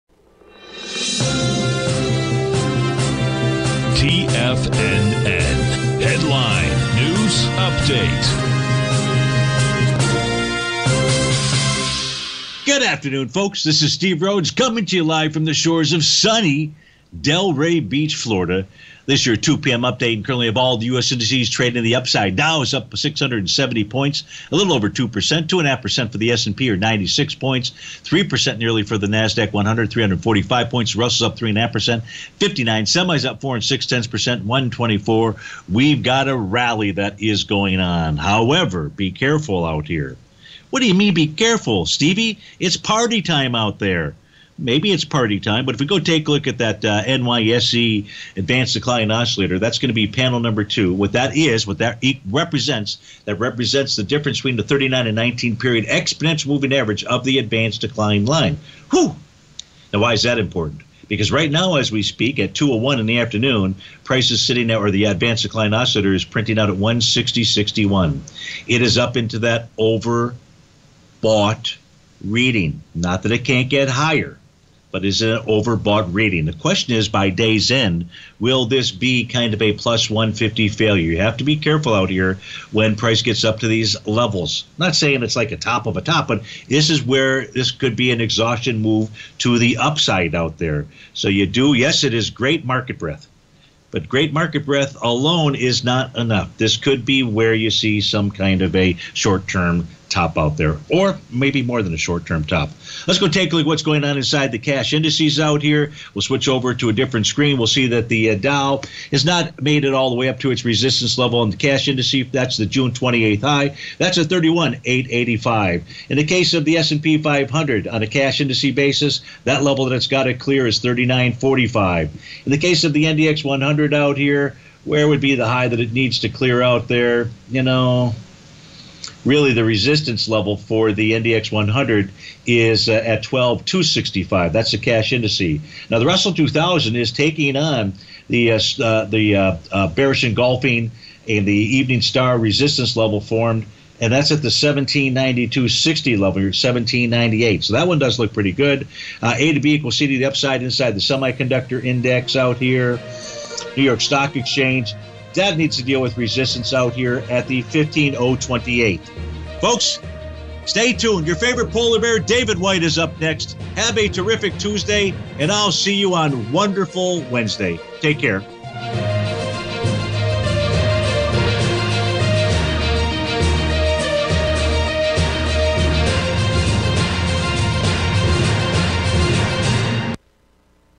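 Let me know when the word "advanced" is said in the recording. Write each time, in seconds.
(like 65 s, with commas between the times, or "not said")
48 s, 57 s, 65 s.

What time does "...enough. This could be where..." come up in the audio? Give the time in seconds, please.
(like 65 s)
96 s.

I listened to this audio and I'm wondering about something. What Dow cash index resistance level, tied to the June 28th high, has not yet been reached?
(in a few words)
31,885.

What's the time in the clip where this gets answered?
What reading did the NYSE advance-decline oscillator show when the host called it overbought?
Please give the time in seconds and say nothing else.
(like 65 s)
66 s.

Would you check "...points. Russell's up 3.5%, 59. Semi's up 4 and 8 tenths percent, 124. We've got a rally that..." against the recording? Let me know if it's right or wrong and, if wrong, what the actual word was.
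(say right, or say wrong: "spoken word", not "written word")
wrong: "6", not "8".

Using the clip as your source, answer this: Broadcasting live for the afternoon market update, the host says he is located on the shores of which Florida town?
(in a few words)
Delray Beach.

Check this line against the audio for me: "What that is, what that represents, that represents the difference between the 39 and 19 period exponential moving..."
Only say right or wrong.
right.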